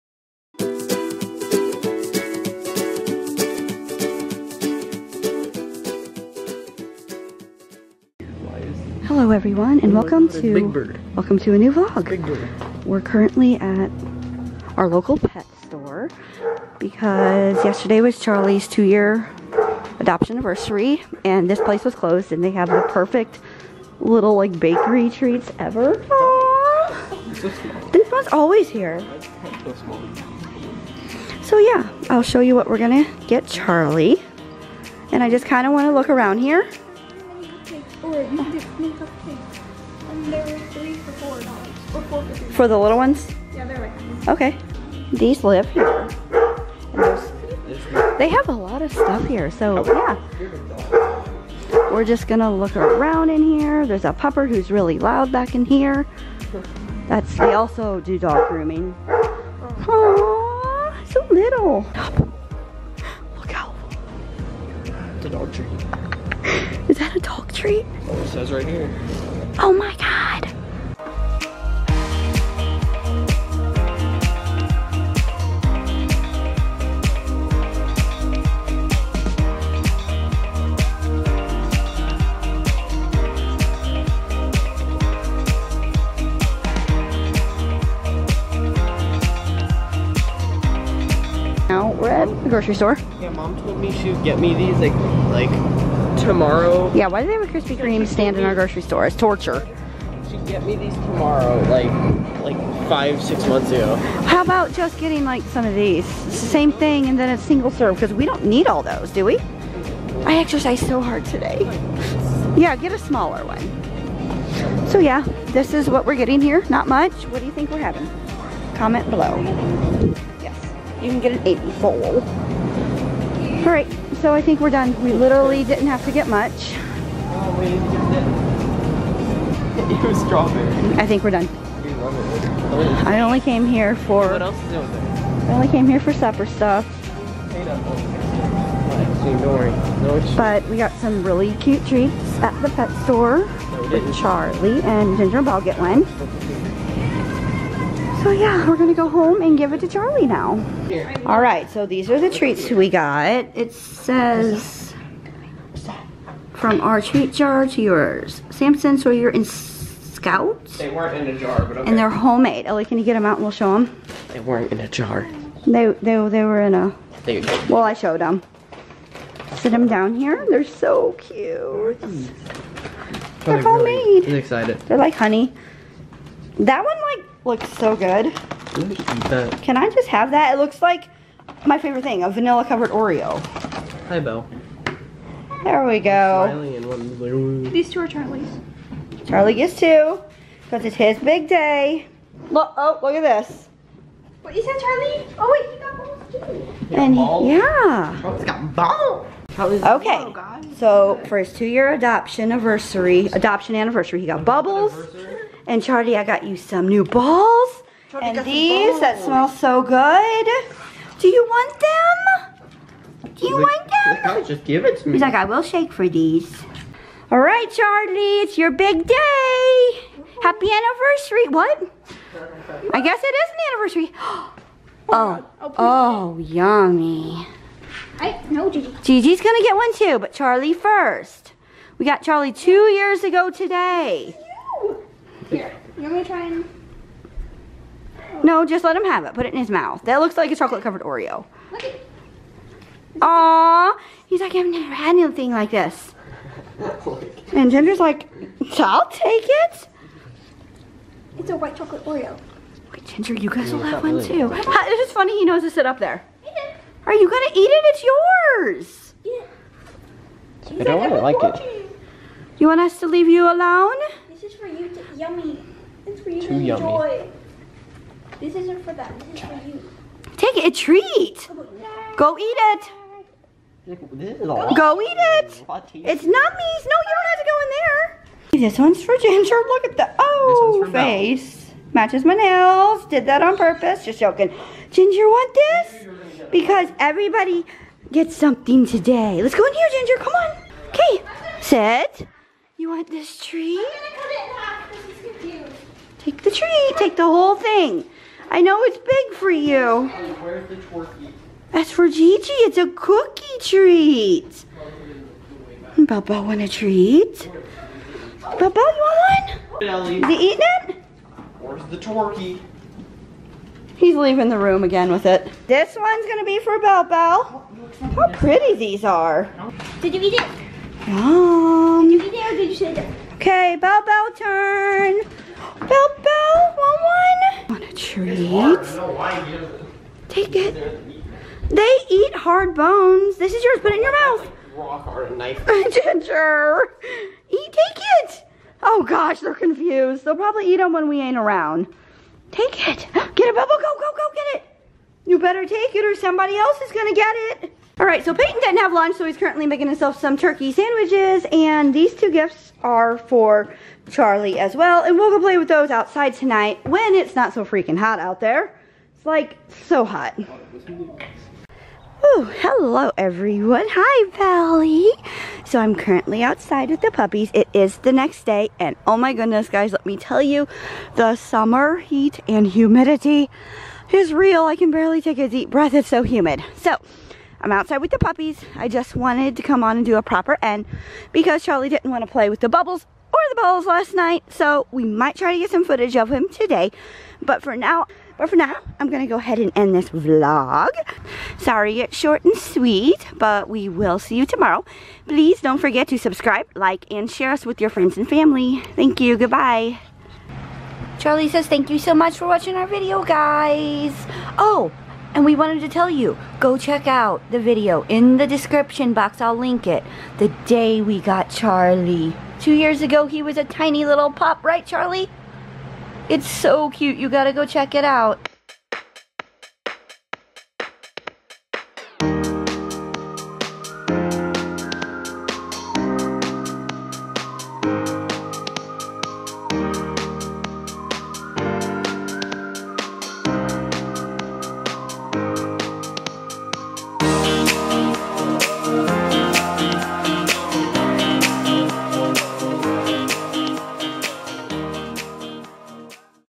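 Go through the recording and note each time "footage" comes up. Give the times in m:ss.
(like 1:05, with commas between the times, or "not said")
6:25.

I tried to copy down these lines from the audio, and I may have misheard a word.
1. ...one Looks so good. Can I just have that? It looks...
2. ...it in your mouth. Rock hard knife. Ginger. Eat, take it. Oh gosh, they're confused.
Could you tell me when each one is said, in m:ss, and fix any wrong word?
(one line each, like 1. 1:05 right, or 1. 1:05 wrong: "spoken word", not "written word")
1. 2:56 right
2. 5:33 right.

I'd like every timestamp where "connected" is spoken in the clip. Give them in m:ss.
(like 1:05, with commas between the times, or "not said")
not said.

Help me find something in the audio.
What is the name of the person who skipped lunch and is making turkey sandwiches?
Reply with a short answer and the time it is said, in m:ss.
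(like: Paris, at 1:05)
Peyton, at 5:48.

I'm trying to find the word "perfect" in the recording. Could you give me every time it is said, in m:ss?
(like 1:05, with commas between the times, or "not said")
0:22.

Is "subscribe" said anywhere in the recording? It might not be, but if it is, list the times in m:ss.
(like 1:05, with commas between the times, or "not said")
6:36.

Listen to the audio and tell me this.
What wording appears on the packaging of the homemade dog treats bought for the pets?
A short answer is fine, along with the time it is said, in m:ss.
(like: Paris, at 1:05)
From our treat jar to yours, at 2:36.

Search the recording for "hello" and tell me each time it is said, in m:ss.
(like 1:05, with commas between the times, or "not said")
0:09, 6:02.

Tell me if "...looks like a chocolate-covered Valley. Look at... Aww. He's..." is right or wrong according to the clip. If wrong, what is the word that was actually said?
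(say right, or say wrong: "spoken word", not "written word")
wrong: "Oreo", not "Valley".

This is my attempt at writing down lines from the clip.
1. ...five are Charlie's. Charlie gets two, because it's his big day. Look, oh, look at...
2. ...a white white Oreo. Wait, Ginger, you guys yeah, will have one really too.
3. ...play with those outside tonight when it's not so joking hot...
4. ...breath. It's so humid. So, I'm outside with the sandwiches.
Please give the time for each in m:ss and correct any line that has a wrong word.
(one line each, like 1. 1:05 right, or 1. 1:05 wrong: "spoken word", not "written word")
1. 3:07 wrong: "two", not "five"
2. 4:11 wrong: "chocolate", not "white"
3. 5:55 wrong: "freaking", not "joking"
4. 6:15 wrong: "puppies", not "sandwiches".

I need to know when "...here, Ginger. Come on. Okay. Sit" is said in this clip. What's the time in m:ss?
4:49.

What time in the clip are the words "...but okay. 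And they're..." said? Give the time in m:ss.
2:41.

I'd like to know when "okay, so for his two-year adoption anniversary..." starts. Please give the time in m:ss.
3:20.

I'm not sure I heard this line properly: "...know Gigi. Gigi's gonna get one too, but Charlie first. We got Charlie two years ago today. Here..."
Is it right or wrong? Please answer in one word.
right.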